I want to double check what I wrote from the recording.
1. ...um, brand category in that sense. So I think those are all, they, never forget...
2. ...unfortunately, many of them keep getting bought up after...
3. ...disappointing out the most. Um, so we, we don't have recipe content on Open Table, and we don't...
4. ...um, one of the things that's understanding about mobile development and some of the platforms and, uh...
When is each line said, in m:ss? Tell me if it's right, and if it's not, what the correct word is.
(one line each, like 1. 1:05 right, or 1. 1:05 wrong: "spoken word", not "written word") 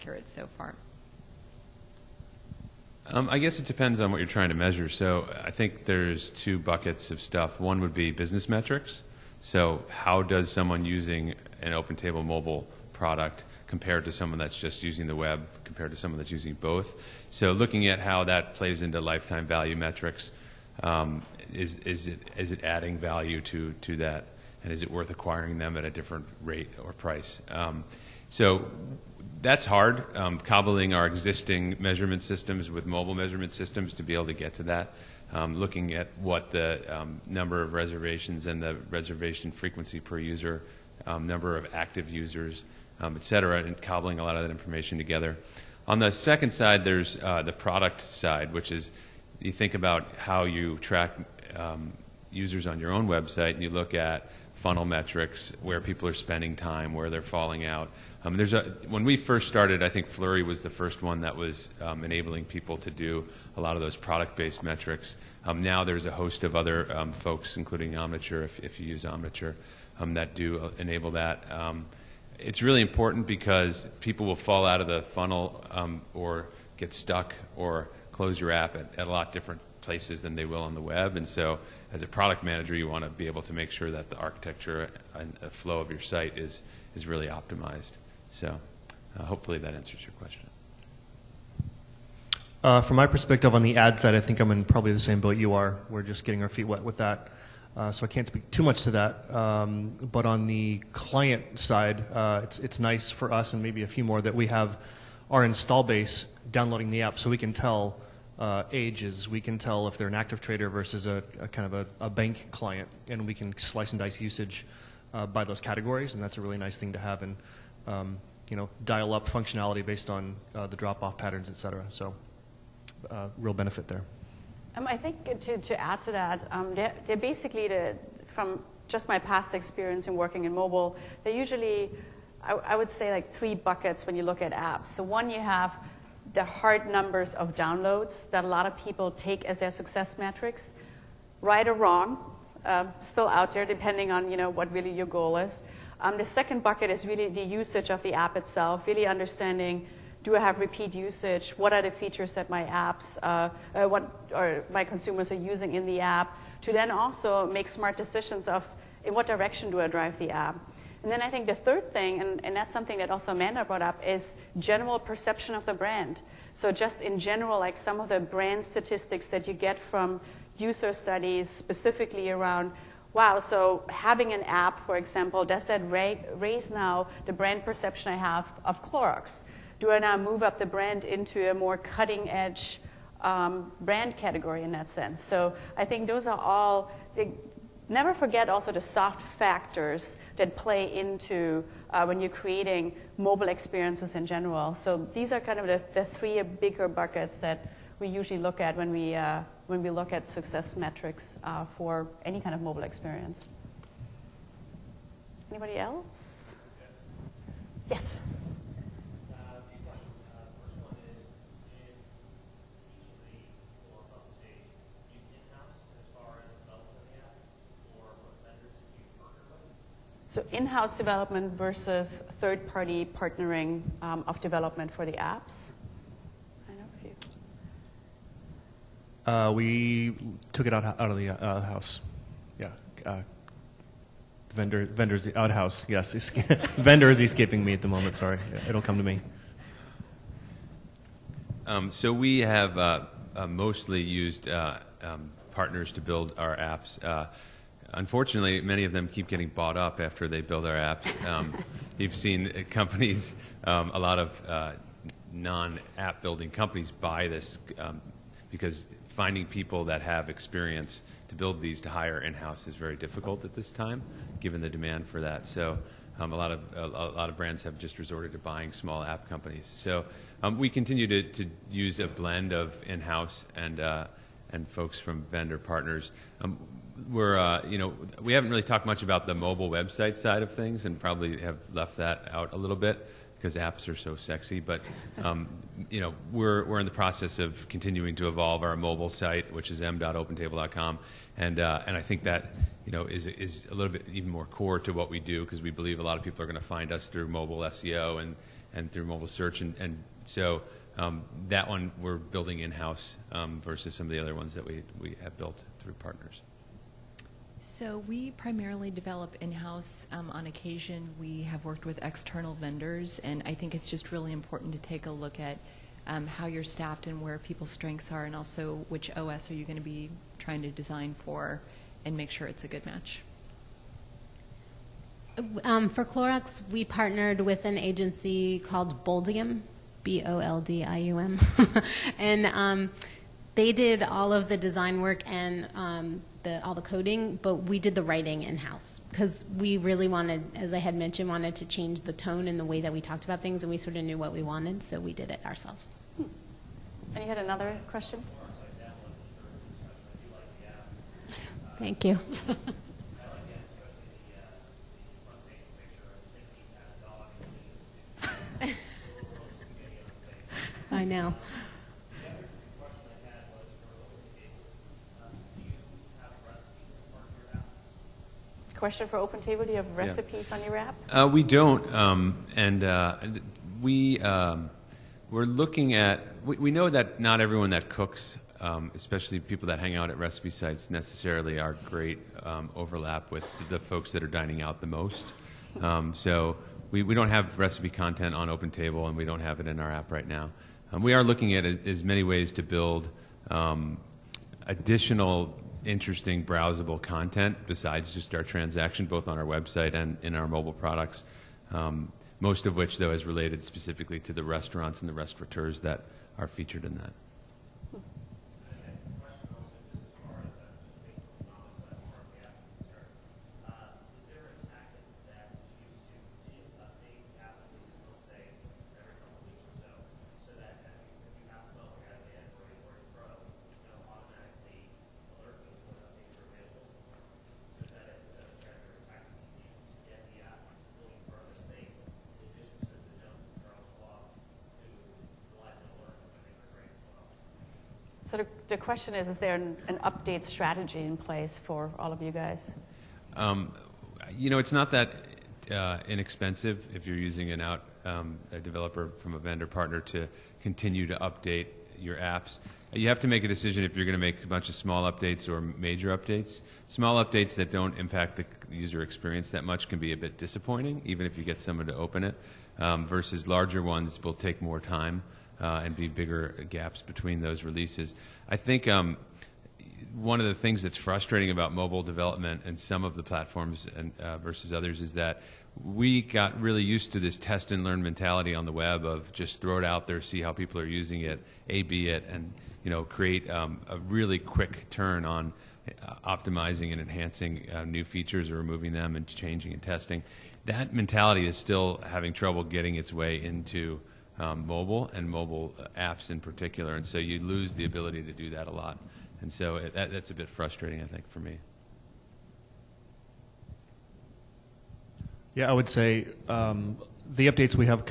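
1. 3:03 right
2. 4:07 right
3. 6:24 wrong: "dining", not "disappointing"
4. 7:48 wrong: "frustrating", not "understanding".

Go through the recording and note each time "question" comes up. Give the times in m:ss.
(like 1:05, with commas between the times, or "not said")
1:30, 5:47, 6:08, 7:18.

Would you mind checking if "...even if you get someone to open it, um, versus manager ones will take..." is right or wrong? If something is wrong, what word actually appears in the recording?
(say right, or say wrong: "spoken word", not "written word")
wrong: "larger", not "manager".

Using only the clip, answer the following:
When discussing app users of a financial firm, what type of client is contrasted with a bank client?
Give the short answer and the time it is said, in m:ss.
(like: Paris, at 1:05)
active trader, at 1:50.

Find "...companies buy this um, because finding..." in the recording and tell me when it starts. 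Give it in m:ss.
4:16.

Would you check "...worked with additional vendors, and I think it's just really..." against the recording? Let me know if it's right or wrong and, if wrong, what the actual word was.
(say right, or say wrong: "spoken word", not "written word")
wrong: "external", not "additional".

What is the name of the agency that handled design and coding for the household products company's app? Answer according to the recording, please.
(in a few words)
Boldium.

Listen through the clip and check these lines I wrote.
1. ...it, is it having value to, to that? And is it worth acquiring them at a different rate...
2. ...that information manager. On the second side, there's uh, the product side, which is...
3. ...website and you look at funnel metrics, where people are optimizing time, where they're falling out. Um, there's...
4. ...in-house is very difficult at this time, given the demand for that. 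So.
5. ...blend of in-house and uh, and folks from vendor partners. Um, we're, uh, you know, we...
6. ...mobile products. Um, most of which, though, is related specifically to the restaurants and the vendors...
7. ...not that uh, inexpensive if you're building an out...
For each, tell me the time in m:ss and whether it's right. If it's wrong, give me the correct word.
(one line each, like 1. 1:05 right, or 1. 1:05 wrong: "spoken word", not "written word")
1. 0:22 wrong: "adding", not "having"
2. 0:44 wrong: "together", not "manager"
3. 0:53 wrong: "spending", not "optimizing"
4. 4:22 right
5. 4:32 right
6. 6:40 wrong: "restaurateurs", not "vendors"
7. 7:24 wrong: "using", not "building".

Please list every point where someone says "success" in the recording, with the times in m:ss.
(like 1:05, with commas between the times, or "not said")
2:19, 3:20.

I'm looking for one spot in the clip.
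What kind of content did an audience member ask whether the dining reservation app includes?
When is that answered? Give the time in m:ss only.
6:09.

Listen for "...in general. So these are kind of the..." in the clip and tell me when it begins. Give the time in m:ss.
3:14.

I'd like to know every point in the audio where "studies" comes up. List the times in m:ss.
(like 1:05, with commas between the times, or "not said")
2:50.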